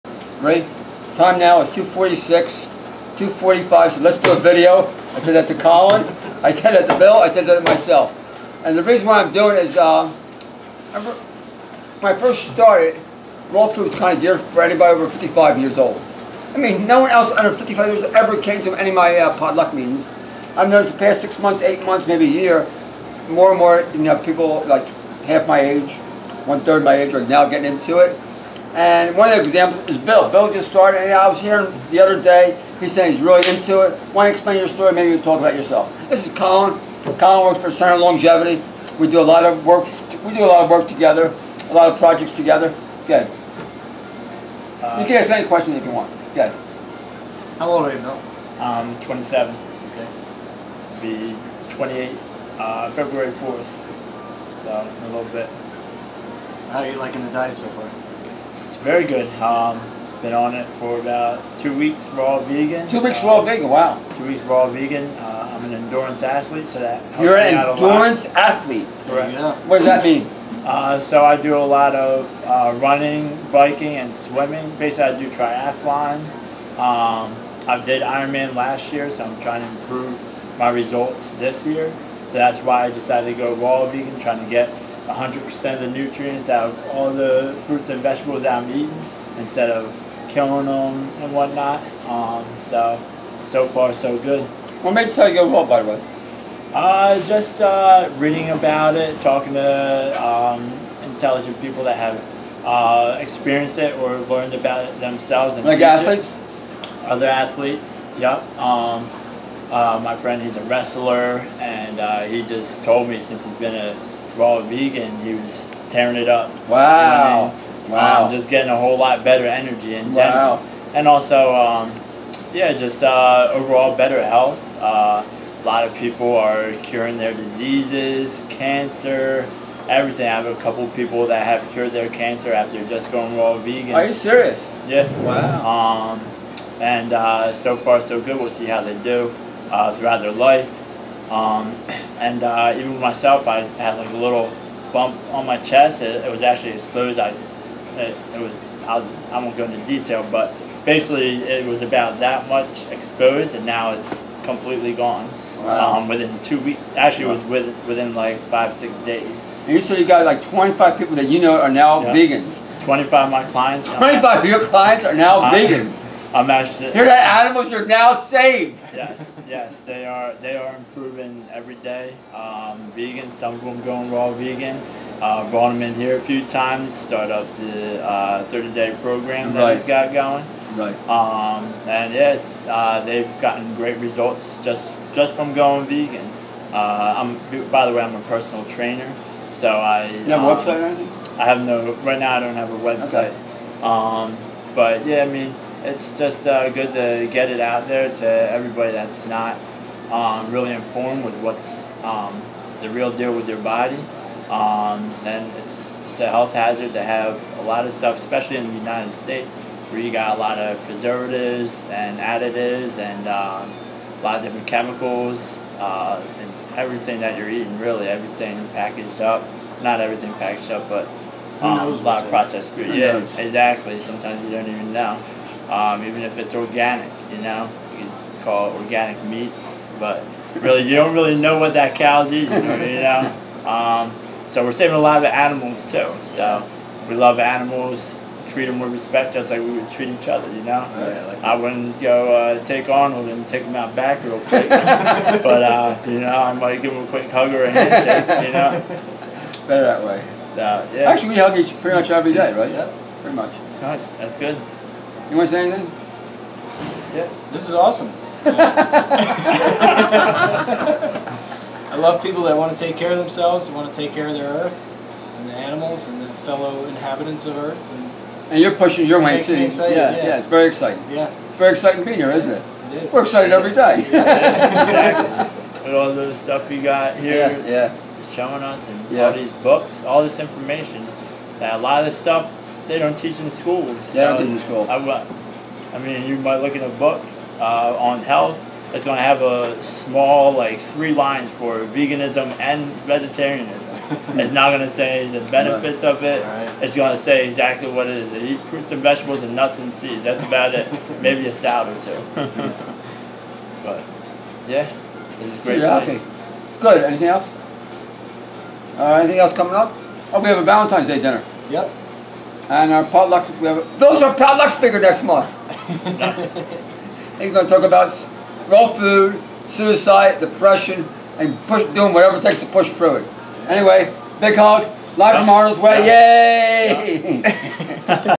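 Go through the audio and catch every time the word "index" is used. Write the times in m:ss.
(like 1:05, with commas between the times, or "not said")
not said.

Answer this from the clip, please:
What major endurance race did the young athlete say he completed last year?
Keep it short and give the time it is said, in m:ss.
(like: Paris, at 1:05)
Ironman, at 1:18.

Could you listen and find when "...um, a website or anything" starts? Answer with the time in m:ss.
3:10.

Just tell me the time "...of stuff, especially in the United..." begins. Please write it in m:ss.
3:27.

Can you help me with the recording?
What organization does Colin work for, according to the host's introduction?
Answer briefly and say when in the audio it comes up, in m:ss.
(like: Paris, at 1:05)
Center Longevity, at 0:37.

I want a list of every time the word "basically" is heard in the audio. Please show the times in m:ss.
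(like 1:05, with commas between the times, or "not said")
1:14, 2:30.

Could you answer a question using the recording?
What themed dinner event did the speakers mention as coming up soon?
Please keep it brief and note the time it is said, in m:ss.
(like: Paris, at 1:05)
Valentine's Day dinner, at 5:10.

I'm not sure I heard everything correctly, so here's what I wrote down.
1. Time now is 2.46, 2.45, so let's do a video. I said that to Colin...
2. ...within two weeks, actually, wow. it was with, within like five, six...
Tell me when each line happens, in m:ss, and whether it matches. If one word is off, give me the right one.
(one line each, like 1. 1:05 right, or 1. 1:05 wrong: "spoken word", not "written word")
1. 0:01 right
2. 2:36 right.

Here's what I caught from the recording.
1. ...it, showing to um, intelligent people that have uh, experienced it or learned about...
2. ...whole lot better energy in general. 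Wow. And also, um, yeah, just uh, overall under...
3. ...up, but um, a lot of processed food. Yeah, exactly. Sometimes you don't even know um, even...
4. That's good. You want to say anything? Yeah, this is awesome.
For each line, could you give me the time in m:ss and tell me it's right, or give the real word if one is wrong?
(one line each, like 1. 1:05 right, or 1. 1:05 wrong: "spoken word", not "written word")
1. 1:38 wrong: "talking", not "showing"
2. 1:58 wrong: "better", not "under"
3. 3:40 right
4. 4:14 right.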